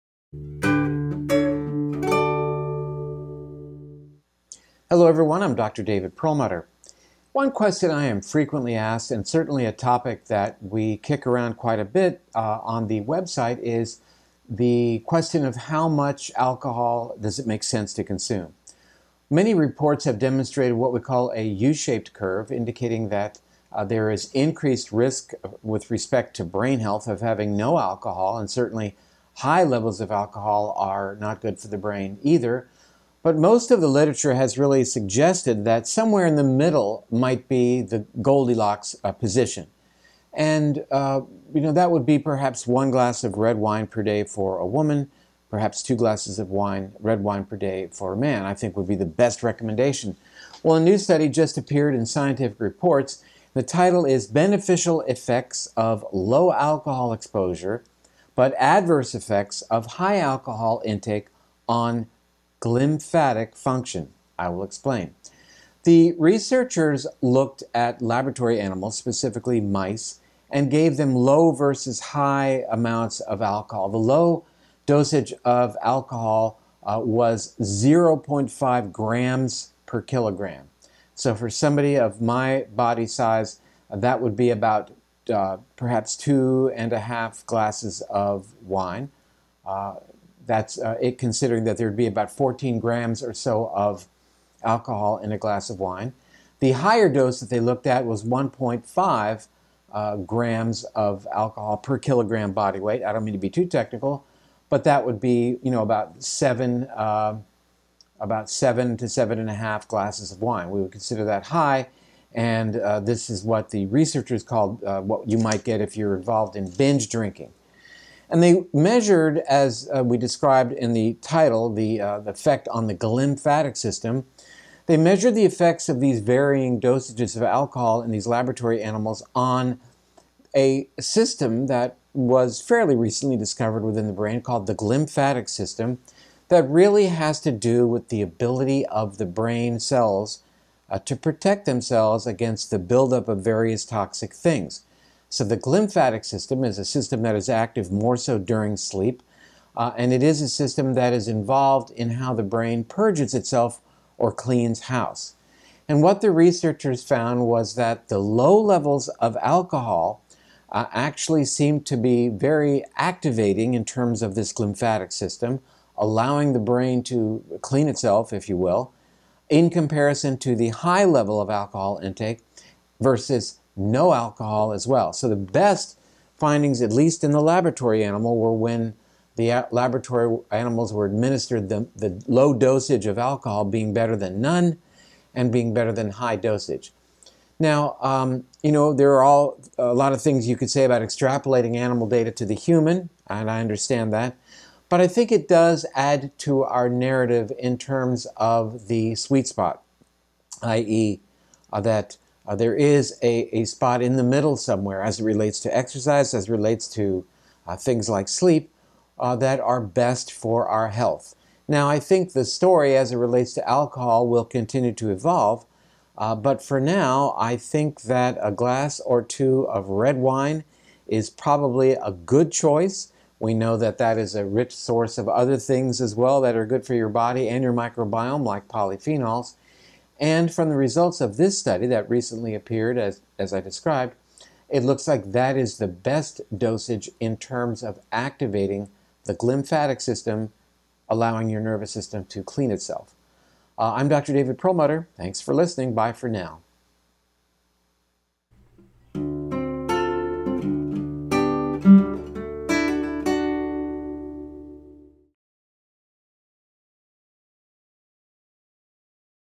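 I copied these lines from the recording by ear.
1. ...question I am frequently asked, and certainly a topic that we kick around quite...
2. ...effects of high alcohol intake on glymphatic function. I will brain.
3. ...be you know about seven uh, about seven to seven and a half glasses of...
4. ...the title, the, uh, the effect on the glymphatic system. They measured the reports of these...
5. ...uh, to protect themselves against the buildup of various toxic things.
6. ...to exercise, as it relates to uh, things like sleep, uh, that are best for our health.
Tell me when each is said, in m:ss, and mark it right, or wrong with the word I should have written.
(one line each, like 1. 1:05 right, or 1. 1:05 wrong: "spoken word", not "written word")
1. 0:07 right
2. 0:59 wrong: "explain", not "brain"
3. 1:45 right
4. 2:00 wrong: "effects", not "reports"
5. 2:20 right
6. 3:25 right.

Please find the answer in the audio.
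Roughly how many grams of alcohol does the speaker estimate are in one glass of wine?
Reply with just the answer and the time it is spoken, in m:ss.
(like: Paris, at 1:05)
14 grams, at 1:32.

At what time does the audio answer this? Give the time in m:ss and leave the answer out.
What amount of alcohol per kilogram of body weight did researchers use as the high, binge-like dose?
1:38.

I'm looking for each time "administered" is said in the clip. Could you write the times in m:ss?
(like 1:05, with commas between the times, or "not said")
3:01.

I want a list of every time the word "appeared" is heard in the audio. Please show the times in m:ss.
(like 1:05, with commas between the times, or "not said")
0:51, 3:52.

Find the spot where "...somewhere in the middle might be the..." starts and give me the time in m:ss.
0:35.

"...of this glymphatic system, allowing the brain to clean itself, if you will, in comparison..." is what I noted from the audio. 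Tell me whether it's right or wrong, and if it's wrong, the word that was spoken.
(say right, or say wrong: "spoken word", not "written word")
right.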